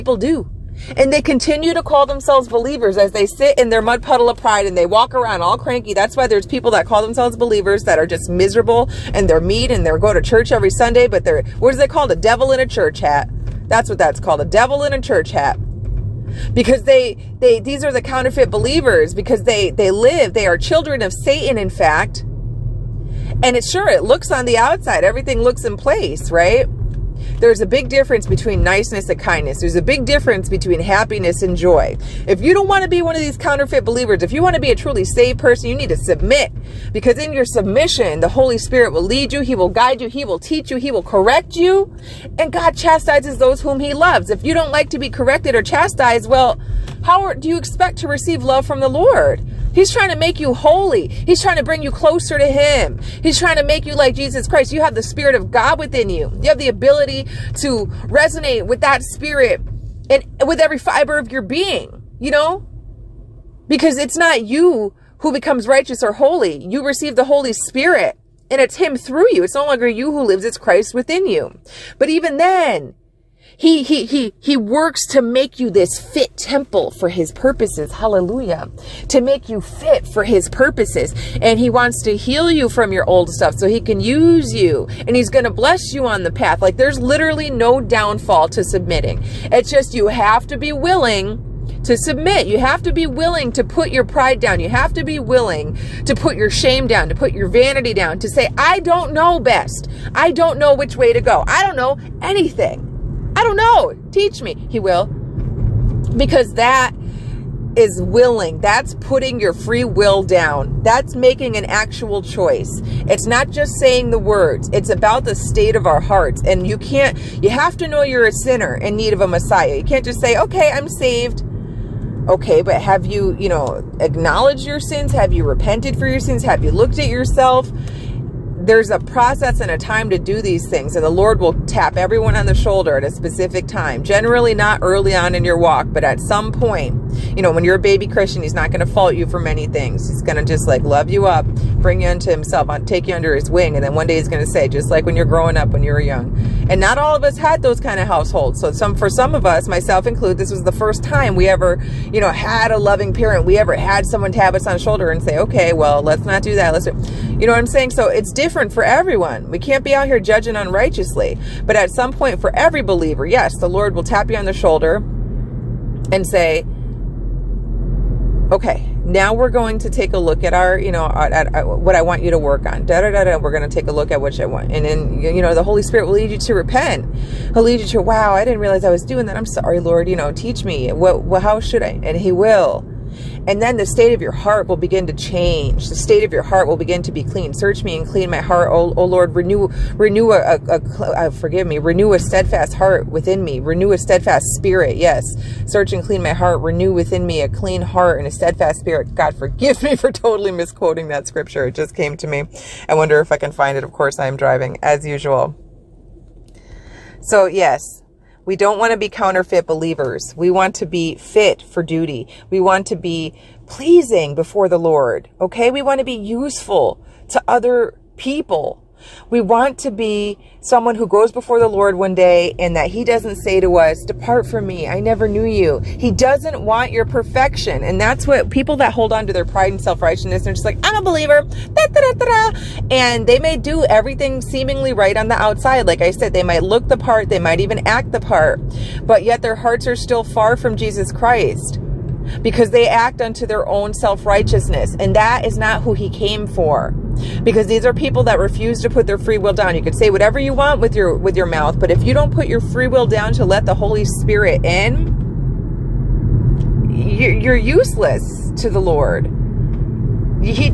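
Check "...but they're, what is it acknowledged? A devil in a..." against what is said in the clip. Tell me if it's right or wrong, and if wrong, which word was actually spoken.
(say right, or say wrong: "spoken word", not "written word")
wrong: "called", not "acknowledged".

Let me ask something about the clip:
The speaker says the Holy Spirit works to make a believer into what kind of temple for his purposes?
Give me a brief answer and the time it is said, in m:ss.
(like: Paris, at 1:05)
Fit temple, at 1:16.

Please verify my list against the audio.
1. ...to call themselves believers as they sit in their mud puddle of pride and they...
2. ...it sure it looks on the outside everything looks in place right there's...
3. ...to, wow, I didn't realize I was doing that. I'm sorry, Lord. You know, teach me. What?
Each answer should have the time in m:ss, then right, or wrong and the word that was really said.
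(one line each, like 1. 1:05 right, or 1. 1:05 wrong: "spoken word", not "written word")
1. 0:01 right
2. 0:23 right
3. 2:57 right.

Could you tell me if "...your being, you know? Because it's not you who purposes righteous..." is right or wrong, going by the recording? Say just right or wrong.
wrong.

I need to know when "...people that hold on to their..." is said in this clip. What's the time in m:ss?
3:48.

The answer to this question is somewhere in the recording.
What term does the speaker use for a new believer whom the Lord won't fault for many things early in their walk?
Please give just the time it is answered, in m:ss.
2:17.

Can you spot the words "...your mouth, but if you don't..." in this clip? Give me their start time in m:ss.
4:11.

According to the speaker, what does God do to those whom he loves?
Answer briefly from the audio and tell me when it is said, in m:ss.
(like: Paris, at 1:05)
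Chastises, at 0:42.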